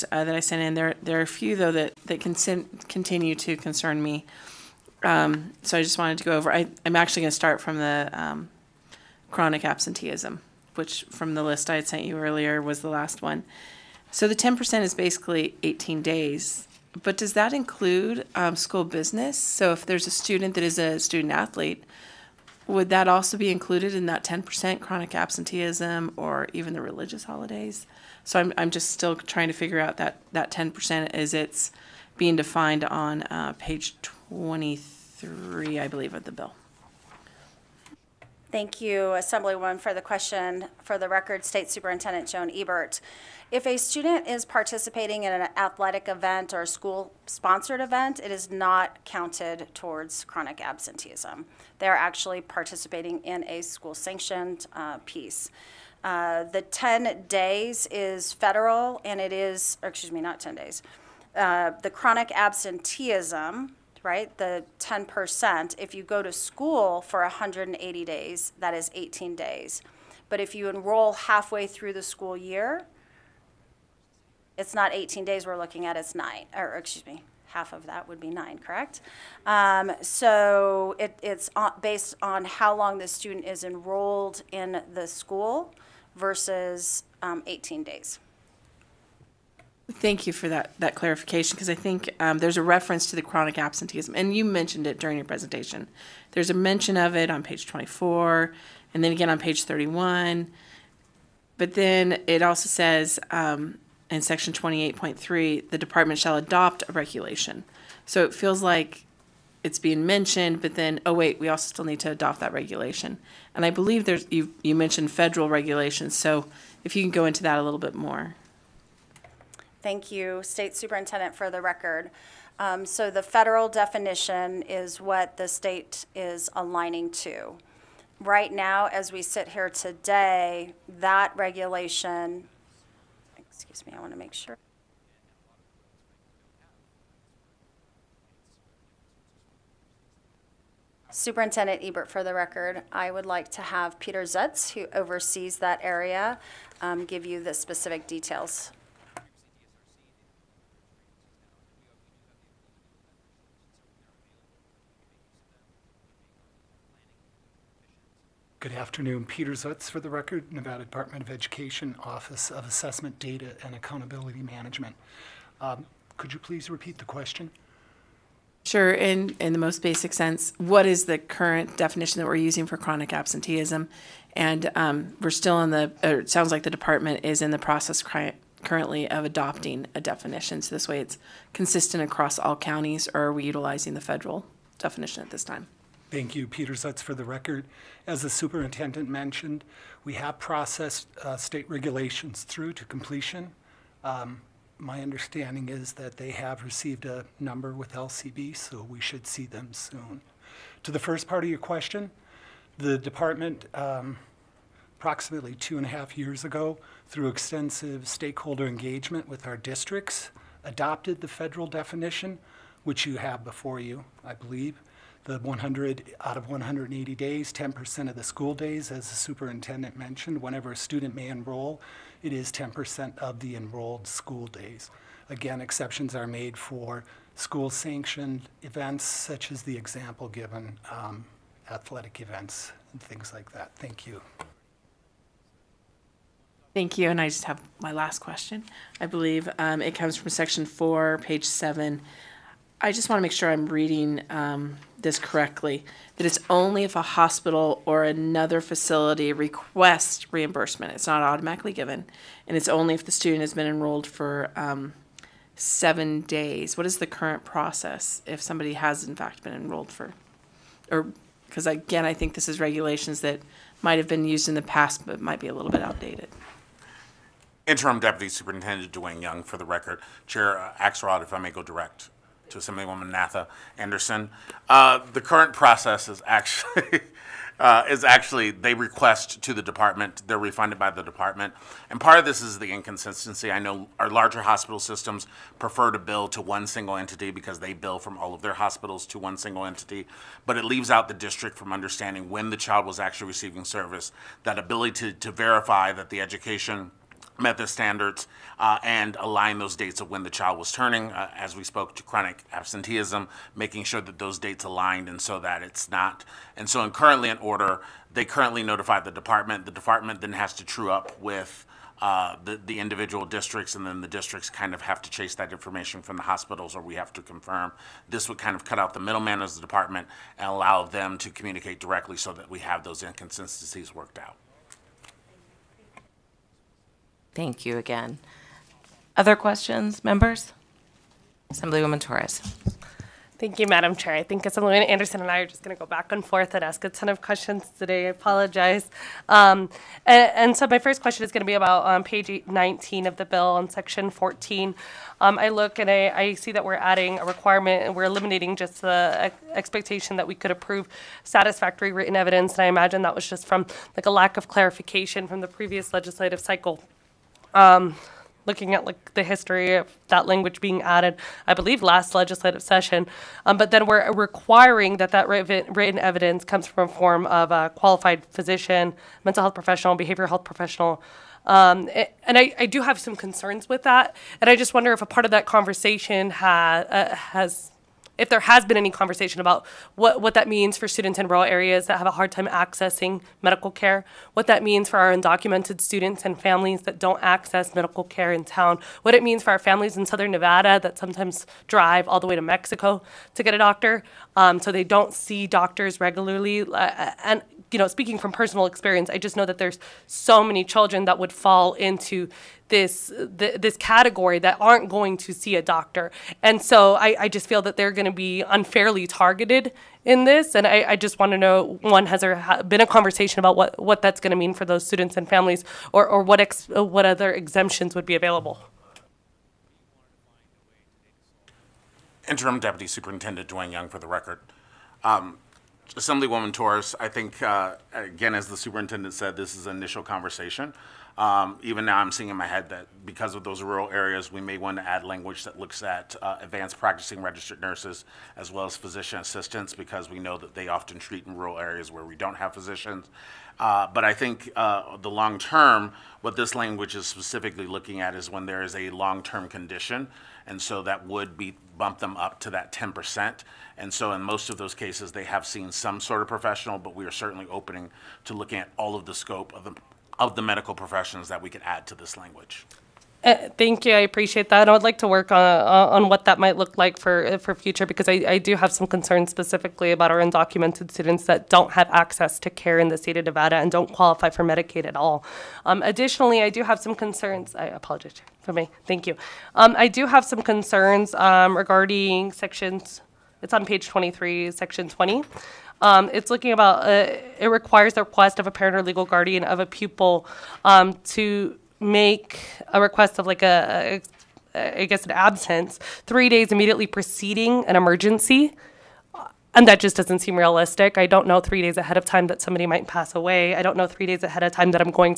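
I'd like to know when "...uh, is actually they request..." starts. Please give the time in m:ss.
4:37.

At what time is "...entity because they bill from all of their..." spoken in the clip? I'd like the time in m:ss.
4:46.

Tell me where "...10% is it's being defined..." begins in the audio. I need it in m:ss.
0:30.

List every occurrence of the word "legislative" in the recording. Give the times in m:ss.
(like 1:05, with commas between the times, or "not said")
5:55, 6:02.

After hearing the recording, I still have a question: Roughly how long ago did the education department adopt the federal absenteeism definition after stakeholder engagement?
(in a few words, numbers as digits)
two and a half years.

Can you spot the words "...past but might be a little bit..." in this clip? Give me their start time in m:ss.
4:24.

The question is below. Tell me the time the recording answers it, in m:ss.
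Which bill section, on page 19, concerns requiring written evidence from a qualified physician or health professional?
5:43.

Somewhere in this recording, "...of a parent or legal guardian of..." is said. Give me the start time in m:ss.
8:08.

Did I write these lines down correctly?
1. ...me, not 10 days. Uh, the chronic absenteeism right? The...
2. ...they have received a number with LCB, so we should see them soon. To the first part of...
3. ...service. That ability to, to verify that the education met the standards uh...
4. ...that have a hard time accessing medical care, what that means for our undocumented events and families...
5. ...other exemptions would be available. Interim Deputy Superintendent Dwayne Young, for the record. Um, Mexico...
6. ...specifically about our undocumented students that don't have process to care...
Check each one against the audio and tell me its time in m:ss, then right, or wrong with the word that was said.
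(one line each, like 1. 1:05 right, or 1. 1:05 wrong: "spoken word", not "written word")
1. 1:00 right
2. 3:16 right
3. 4:53 right
4. 6:21 wrong: "students", not "events"
5. 6:57 wrong: "Assemblywoman", not "Mexico"
6. 7:49 wrong: "access", not "process".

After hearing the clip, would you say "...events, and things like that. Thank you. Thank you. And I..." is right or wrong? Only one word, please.
right.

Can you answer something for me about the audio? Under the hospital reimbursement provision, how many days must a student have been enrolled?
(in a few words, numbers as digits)
7 days.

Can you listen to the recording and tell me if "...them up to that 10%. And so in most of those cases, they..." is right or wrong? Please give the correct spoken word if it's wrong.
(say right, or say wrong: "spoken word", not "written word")
right.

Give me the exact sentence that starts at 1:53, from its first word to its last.
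And I believe there's you you mentioned federal regulations, so if you can go into that a little bit more.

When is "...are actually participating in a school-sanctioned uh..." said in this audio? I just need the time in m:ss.
0:51.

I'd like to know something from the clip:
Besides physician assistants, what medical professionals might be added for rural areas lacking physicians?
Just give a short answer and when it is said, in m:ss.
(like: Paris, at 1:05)
advanced practicing registered nurses, at 7:16.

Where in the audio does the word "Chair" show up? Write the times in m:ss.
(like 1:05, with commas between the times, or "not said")
4:30, 5:33.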